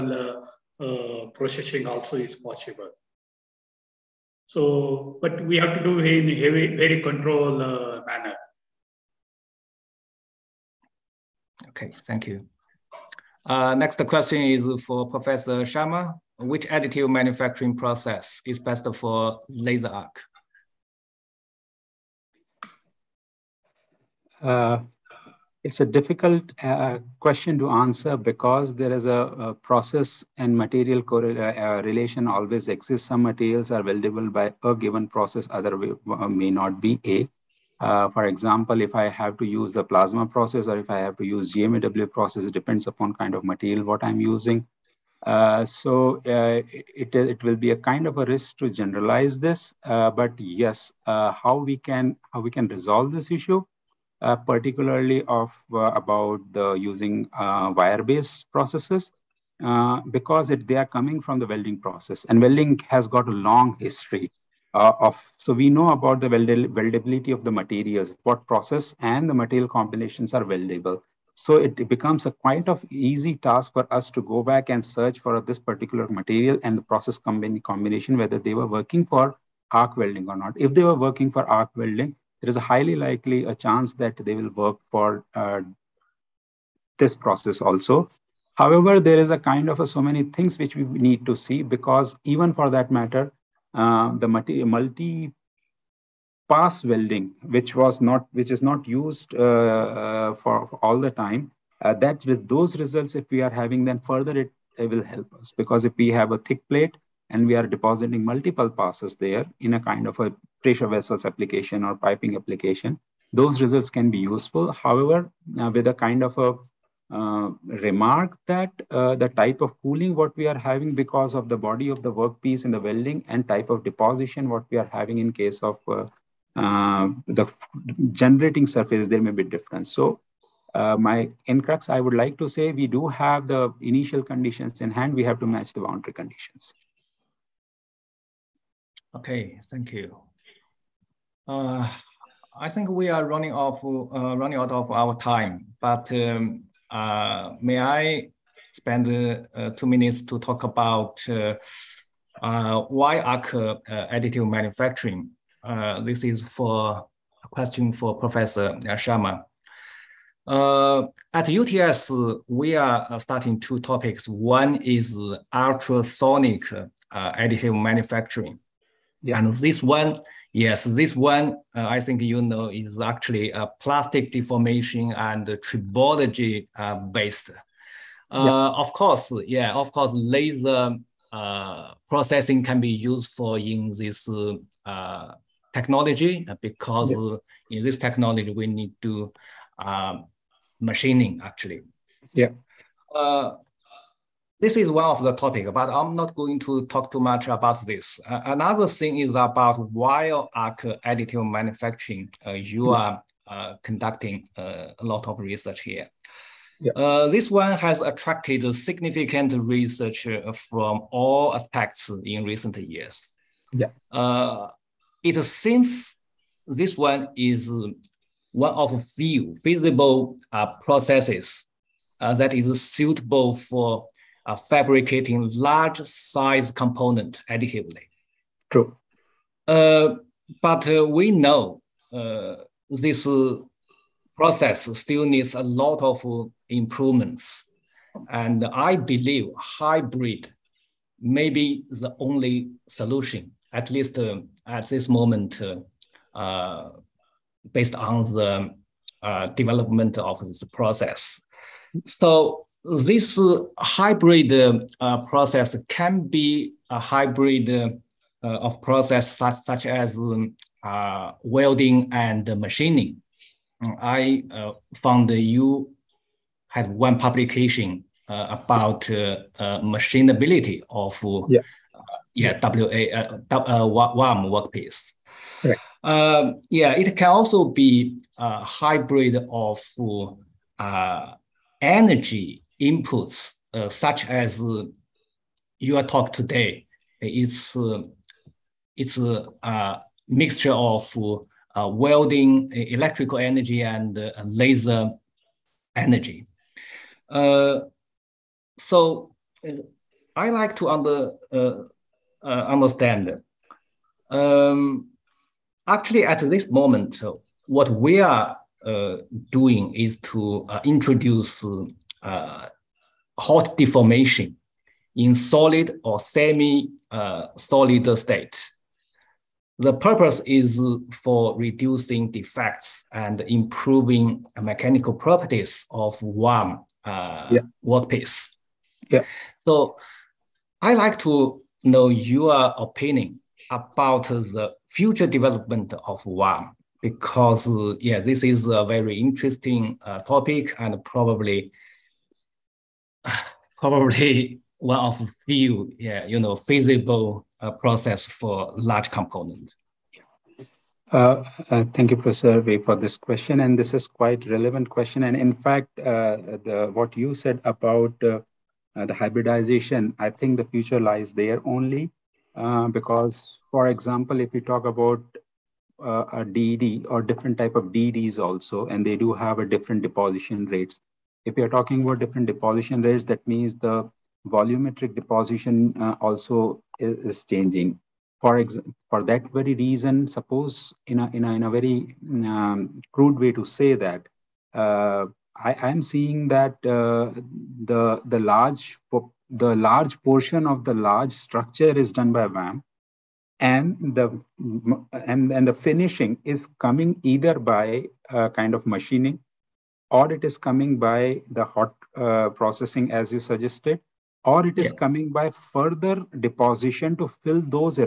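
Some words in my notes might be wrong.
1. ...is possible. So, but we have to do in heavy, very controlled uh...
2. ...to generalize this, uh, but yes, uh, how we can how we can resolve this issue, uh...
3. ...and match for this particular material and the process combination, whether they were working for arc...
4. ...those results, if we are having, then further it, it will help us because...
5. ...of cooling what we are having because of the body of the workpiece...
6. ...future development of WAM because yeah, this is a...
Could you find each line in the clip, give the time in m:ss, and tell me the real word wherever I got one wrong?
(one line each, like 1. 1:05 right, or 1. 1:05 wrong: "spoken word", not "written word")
1. 0:02 right
2. 0:48 right
3. 1:14 wrong: "search", not "match"
4. 1:42 right
5. 1:59 right
6. 5:34 right.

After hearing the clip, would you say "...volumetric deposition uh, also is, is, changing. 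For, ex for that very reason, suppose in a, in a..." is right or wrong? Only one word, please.
right.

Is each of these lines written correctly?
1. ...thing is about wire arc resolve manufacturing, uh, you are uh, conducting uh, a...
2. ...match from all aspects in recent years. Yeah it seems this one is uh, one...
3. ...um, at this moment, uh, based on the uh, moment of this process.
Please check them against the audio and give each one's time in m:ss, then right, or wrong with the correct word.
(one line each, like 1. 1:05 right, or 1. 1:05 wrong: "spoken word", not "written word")
1. 3:18 wrong: "additive", not "resolve"
2. 3:29 wrong: "research", not "match"
3. 4:04 wrong: "development", not "moment".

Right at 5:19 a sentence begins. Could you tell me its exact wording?
The purpose is for reducing defects and improving mechanical properties of one uh, yeah.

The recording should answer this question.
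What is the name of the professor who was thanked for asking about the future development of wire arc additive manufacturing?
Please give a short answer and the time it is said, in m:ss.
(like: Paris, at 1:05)
Professor Wei, at 5:52.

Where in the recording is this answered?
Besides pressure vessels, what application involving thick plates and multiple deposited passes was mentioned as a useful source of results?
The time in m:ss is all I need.
1:51.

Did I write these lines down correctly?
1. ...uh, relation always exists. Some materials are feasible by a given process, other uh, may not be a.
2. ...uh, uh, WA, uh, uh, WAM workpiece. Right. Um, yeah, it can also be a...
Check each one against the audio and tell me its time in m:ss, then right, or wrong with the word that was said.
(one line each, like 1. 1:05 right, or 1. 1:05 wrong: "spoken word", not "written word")
1. 0:31 wrong: "weldable", not "feasible"
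2. 4:32 right.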